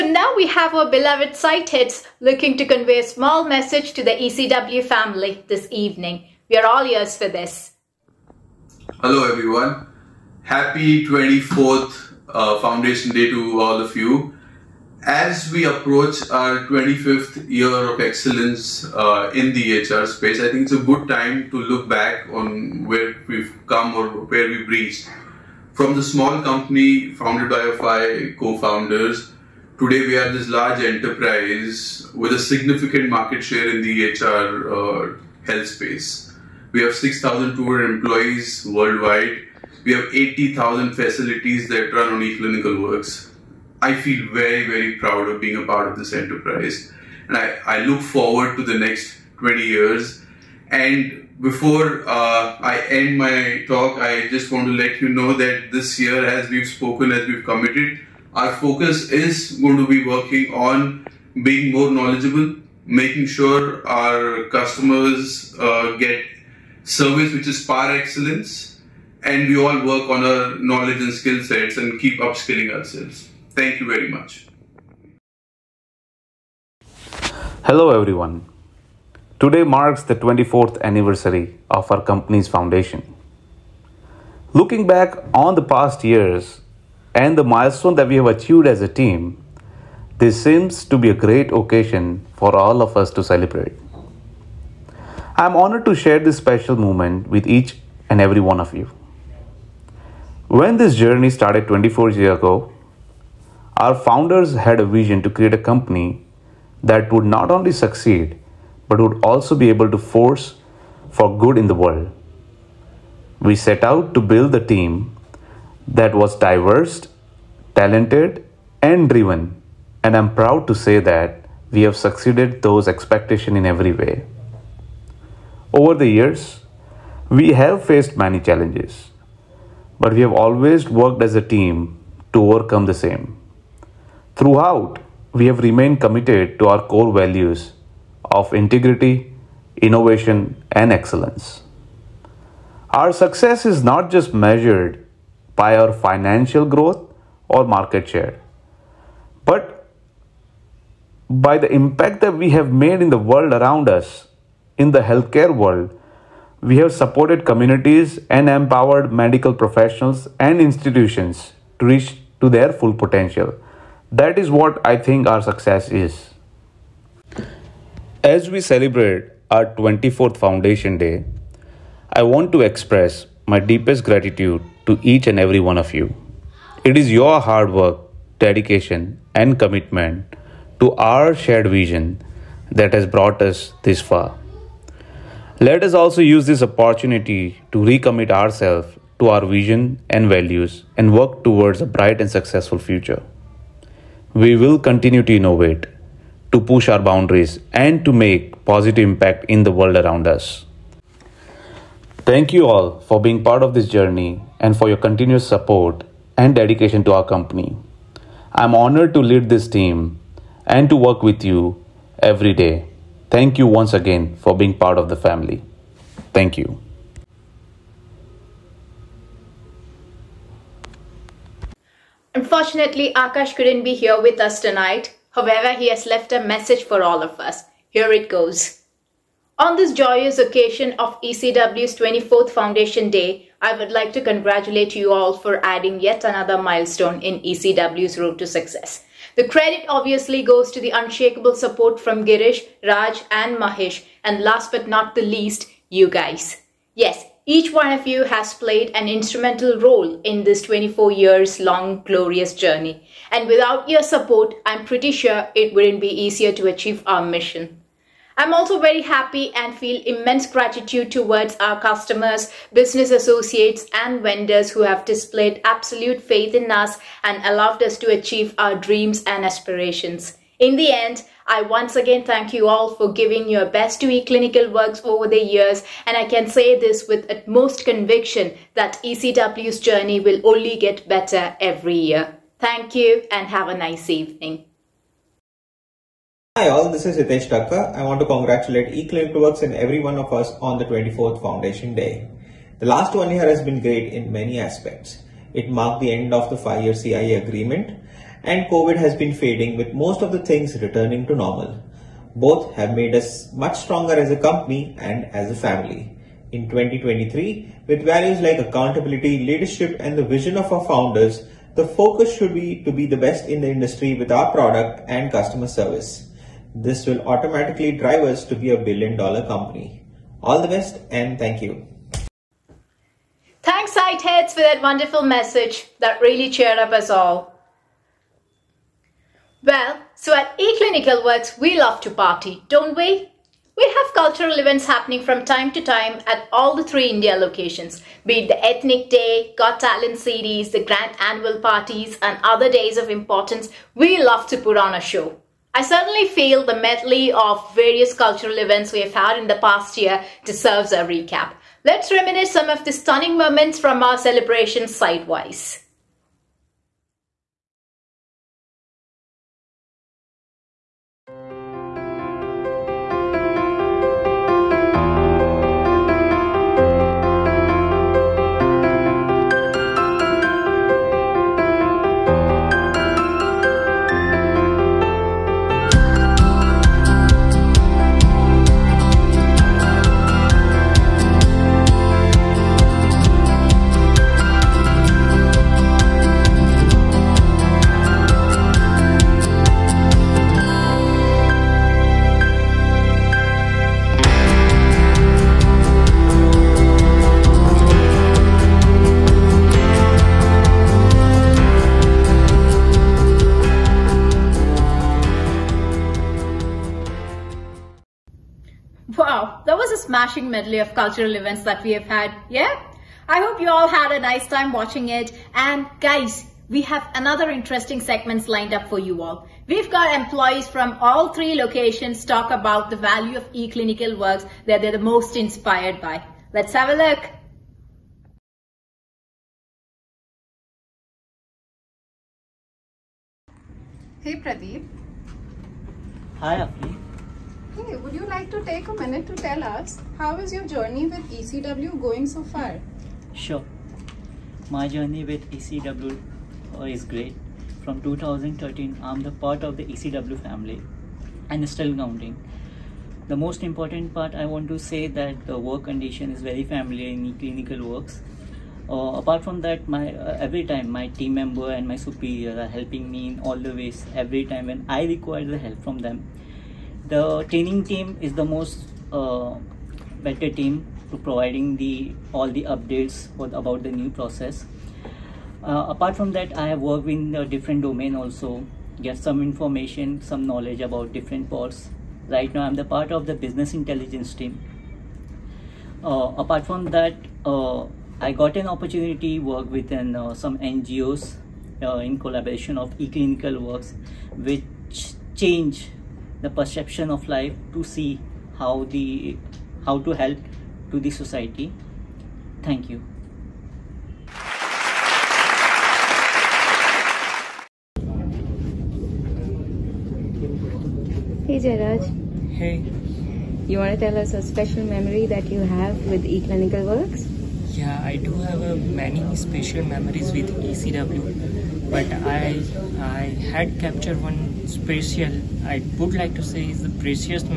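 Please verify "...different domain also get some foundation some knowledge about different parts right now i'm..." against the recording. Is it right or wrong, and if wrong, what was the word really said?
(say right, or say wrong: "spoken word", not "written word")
wrong: "information", not "foundation".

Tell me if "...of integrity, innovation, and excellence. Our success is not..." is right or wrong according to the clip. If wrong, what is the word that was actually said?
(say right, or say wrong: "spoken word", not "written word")
right.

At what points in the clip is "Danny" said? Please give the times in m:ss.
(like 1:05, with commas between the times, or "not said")
not said.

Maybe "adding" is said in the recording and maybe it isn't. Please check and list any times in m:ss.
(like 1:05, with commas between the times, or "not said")
3:55.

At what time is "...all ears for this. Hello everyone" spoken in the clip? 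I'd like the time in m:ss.
0:06.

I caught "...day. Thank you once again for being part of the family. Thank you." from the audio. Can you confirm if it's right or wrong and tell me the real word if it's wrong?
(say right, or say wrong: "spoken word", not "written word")
right.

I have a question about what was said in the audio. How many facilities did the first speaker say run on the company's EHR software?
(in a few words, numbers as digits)
80,000.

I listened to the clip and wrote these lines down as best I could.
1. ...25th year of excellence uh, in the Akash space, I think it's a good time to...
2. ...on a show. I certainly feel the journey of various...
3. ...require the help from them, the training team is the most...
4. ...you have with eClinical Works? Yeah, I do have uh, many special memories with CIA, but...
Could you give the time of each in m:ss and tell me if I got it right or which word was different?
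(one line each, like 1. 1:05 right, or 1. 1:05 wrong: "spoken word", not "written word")
1. 0:16 wrong: "EHR", not "Akash"
2. 5:44 wrong: "medley", not "journey"
3. 7:45 right
4. 8:35 wrong: "ECW", not "CIA".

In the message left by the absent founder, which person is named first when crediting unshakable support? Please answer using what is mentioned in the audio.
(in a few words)
Girish.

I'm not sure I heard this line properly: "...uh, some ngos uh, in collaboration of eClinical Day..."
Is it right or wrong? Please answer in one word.
wrong.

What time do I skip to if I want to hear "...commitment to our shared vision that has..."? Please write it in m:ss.
2:59.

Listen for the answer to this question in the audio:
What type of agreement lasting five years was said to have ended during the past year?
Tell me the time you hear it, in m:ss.
4:56.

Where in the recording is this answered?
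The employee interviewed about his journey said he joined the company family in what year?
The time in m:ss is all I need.
7:28.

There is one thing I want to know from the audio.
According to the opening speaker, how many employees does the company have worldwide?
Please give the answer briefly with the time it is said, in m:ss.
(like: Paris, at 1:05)
6,200, at 0:36.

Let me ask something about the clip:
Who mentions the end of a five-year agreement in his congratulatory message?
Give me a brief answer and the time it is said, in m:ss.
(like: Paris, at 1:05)
Hitesh Thakkar, at 4:47.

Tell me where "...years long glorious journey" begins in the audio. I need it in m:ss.
4:11.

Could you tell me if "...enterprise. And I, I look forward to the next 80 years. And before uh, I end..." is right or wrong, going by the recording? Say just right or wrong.
wrong.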